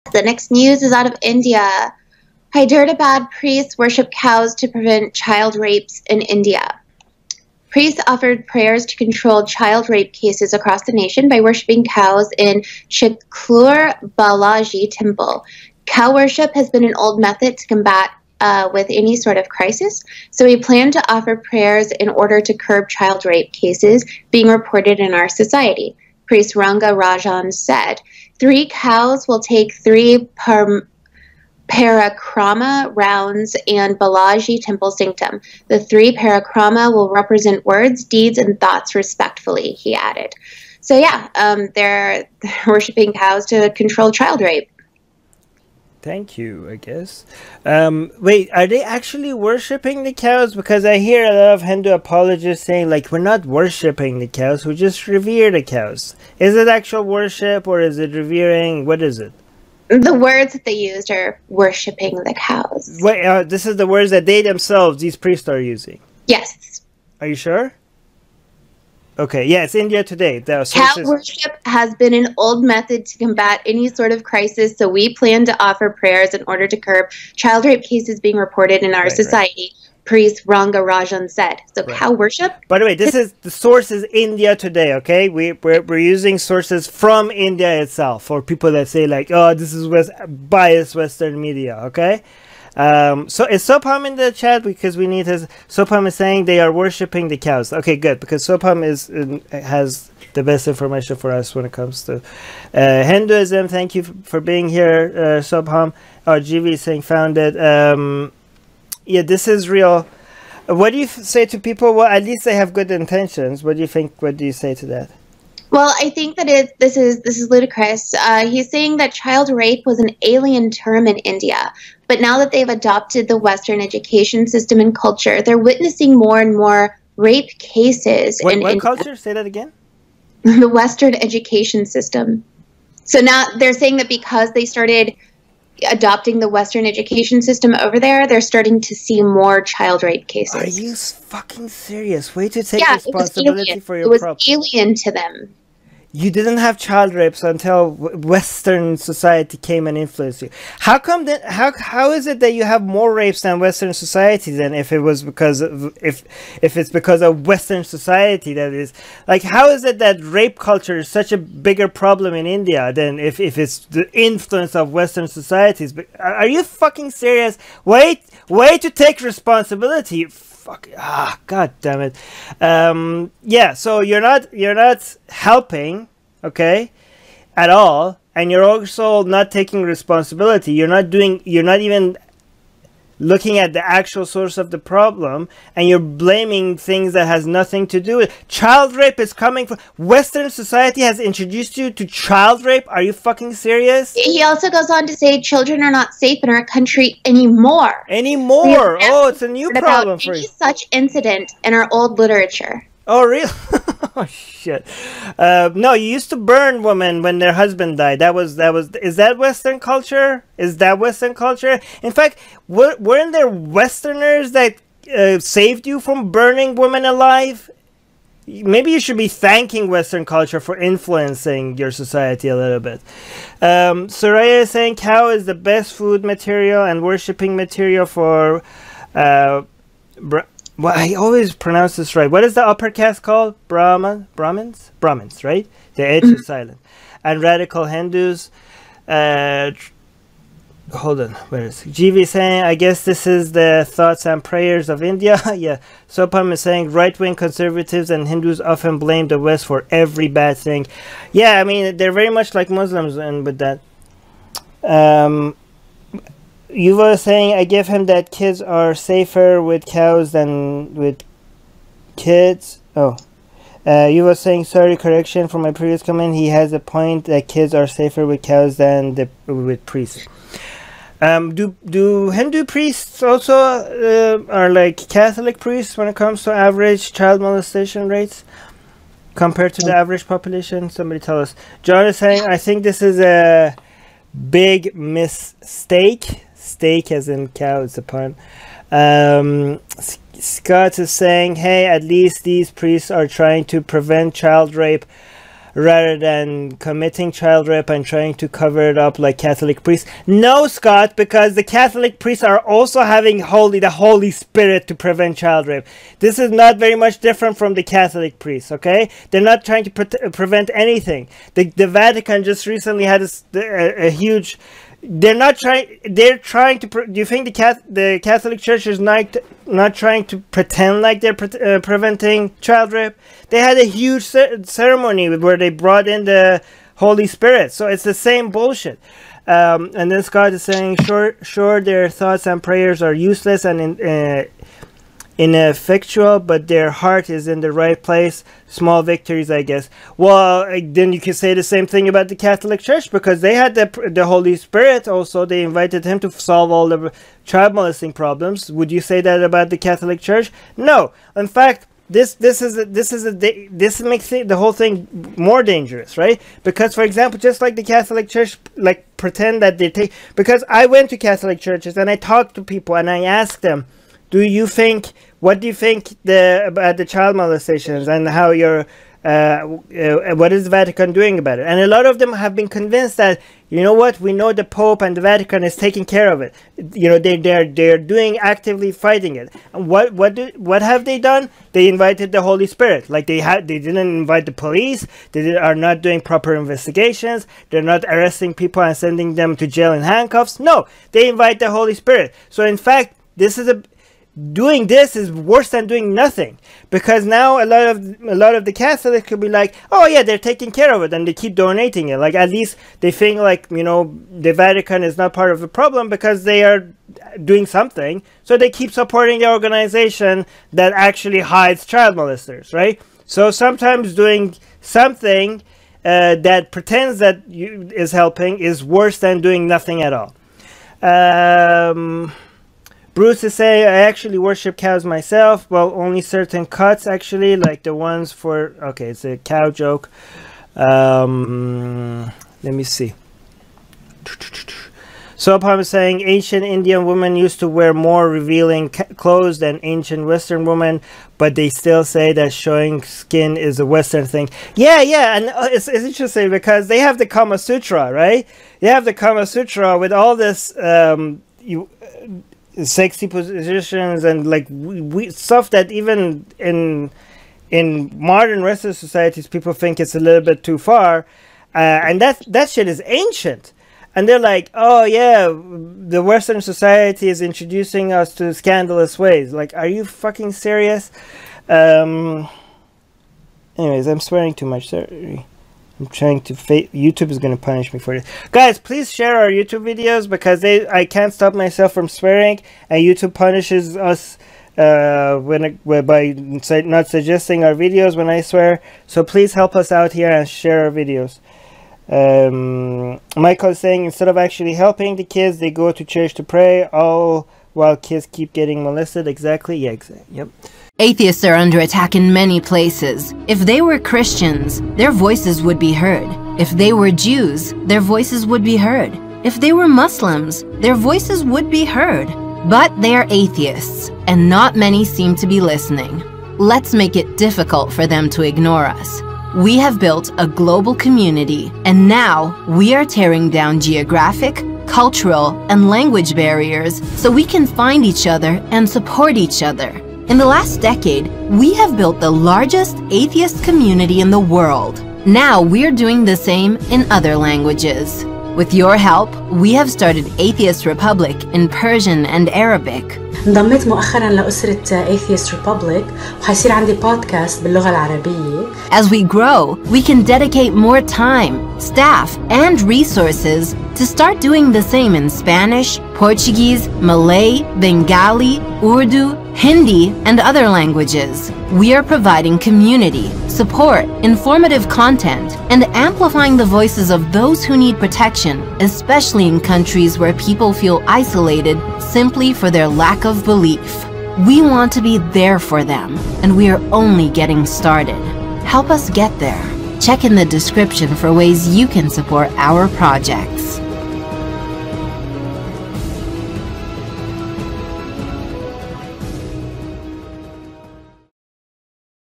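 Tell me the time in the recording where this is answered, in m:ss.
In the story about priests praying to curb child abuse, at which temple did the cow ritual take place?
0:12.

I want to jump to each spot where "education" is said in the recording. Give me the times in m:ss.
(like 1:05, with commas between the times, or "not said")
2:03, 2:11, 2:16.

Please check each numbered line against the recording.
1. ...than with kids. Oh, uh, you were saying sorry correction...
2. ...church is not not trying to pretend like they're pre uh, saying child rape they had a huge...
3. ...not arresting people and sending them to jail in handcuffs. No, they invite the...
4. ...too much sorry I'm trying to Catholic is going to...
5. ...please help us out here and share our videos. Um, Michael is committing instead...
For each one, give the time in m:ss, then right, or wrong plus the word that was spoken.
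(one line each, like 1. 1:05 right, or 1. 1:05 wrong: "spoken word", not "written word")
1. 4:20 right
2. 5:18 wrong: "preventing", not "saying"
3. 6:27 right
4. 7:54 wrong: "YouTube", not "Catholic"
5. 8:09 wrong: "saying", not "committing".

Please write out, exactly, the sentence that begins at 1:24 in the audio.
Okay, we we're, we're using sources from India itself for people that say like, oh, this is West biased Western media.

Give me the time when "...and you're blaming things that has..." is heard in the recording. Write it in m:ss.
3:05.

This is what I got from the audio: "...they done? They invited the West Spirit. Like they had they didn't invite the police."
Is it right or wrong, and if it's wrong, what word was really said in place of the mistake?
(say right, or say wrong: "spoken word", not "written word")
wrong: "Holy", not "West".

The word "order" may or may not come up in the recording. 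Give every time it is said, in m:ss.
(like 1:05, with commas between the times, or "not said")
0:22, 1:16.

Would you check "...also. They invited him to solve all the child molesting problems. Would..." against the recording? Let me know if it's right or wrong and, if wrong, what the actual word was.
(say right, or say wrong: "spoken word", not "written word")
right.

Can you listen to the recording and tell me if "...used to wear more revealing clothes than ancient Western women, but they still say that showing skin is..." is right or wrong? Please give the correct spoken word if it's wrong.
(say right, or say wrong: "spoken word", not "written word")
right.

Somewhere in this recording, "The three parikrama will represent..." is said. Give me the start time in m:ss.
0:35.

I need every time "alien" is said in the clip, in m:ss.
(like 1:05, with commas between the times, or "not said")
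2:00, 2:24.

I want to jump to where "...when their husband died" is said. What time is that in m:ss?
3:27.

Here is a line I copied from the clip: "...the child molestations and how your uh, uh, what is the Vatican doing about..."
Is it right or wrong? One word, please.
right.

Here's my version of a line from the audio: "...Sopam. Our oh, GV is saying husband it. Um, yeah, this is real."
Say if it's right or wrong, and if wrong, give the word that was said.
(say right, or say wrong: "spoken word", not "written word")
wrong: "found", not "husband".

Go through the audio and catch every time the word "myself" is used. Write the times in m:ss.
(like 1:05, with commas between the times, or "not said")
7:05, 8:01.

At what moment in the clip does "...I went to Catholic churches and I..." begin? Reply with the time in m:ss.
6:00.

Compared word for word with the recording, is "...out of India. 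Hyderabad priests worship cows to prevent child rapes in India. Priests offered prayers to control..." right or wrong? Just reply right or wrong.
right.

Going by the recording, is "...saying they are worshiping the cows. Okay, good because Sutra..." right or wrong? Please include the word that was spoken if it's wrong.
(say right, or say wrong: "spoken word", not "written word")
wrong: "Sopam", not "Sutra".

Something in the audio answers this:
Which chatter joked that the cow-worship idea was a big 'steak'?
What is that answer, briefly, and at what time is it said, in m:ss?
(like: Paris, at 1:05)
John, at 4:41.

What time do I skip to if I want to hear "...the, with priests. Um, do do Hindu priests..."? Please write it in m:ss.
4:29.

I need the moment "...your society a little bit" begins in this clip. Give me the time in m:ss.
3:41.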